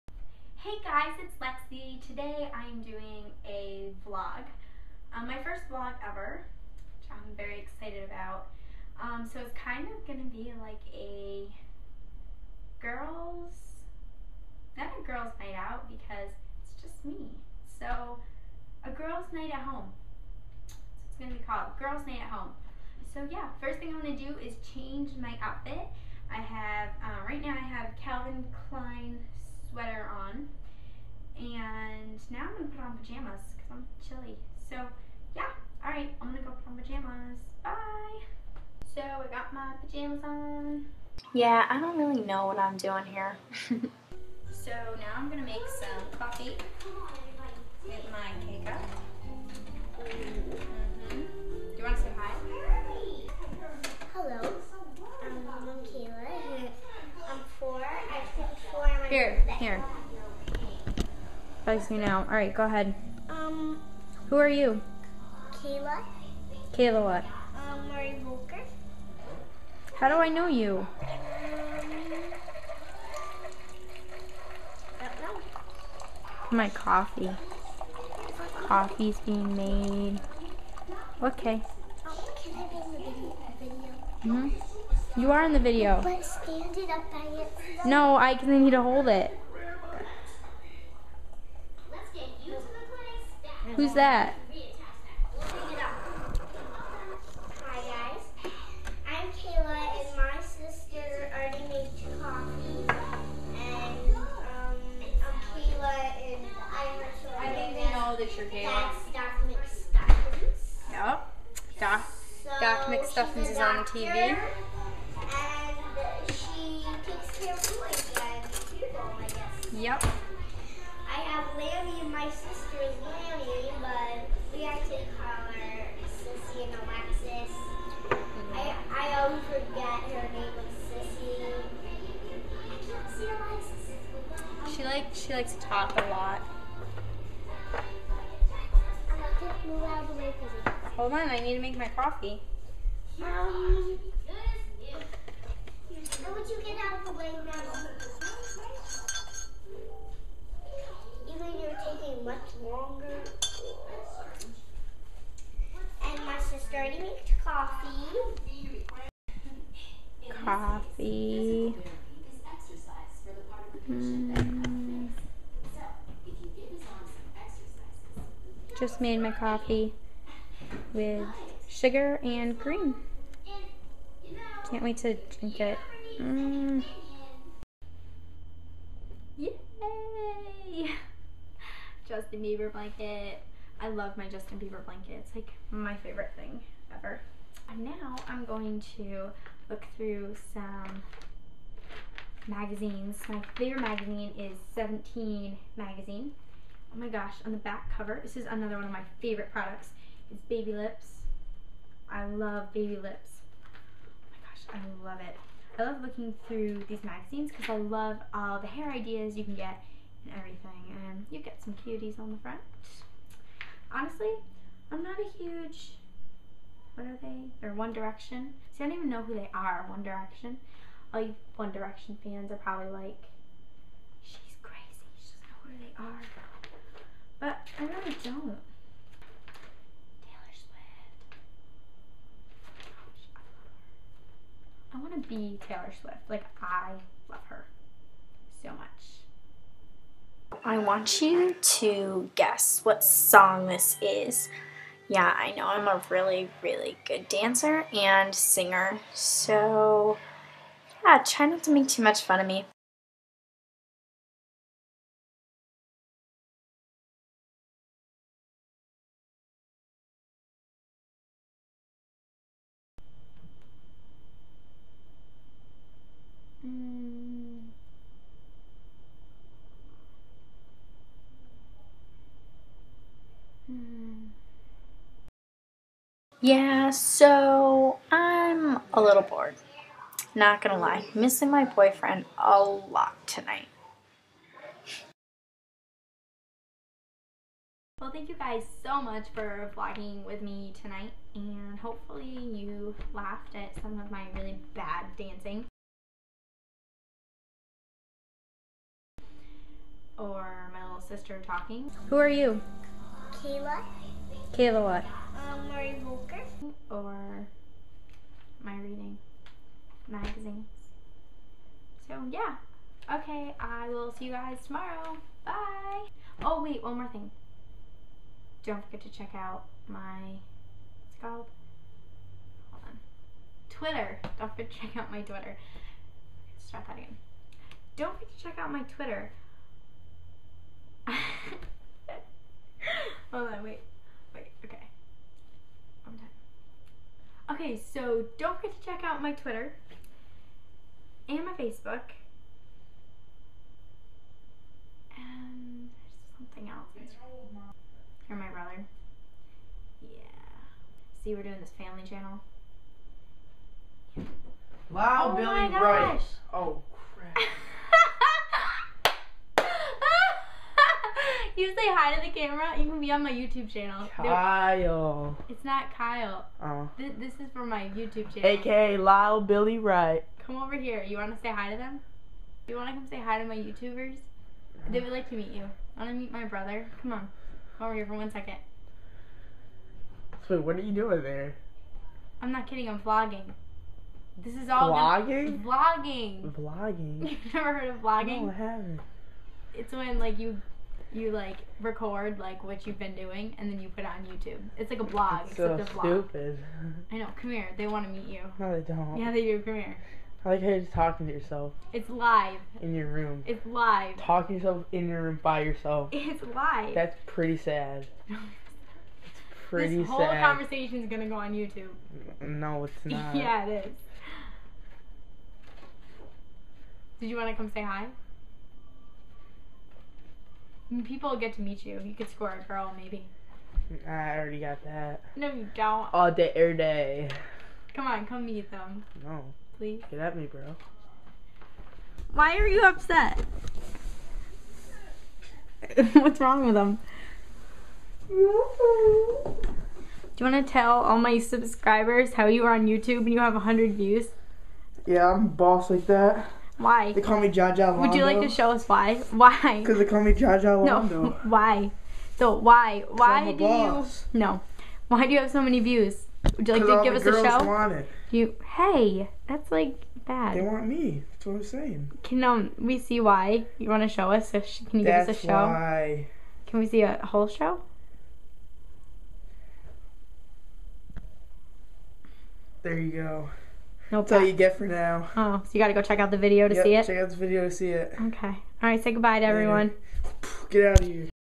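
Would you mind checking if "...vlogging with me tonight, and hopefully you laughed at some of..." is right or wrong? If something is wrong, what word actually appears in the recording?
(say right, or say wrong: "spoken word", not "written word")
right.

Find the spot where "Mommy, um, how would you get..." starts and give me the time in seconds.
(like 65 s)
143 s.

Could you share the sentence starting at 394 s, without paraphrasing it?
It's like a blog, it's except so a Stupid.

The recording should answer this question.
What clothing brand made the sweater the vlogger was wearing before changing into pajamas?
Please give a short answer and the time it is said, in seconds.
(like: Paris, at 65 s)
Calvin Klein, at 27 s.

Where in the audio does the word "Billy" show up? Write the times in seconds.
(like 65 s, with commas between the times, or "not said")
355 s, 369 s.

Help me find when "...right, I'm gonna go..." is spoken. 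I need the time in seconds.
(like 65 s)
35 s.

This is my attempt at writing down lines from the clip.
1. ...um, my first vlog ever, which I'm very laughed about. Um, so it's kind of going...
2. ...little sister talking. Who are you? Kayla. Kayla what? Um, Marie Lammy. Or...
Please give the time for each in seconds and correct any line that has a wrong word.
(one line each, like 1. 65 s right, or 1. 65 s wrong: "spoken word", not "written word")
1. 5 s wrong: "excited", not "laughed"
2. 300 s wrong: "Voelker", not "Lammy".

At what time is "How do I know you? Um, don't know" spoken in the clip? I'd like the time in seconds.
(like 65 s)
69 s.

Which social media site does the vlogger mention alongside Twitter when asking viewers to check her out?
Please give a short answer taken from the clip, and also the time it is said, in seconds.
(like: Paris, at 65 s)
Facebook, at 341 s.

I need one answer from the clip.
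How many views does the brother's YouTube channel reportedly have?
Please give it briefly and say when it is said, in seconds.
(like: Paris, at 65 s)
100, at 443 s.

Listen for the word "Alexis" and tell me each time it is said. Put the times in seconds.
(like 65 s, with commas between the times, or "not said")
126 s, 133 s.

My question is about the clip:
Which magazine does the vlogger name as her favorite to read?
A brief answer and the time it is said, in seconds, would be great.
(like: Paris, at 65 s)
17 magazine, at 194 s.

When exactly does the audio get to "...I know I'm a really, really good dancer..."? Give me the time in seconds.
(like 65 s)
245 s.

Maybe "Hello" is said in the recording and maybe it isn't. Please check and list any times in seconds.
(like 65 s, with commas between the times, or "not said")
54 s.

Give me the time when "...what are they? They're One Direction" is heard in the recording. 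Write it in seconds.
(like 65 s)
216 s.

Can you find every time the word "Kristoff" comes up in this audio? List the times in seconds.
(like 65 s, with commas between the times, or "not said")
not said.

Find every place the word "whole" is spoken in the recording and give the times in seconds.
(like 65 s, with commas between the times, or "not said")
410 s, 467 s.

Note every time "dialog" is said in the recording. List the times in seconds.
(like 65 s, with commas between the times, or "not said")
not said.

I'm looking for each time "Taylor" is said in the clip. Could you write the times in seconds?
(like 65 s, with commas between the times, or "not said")
230 s, 235 s.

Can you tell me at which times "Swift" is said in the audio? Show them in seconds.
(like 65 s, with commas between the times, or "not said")
230 s, 235 s.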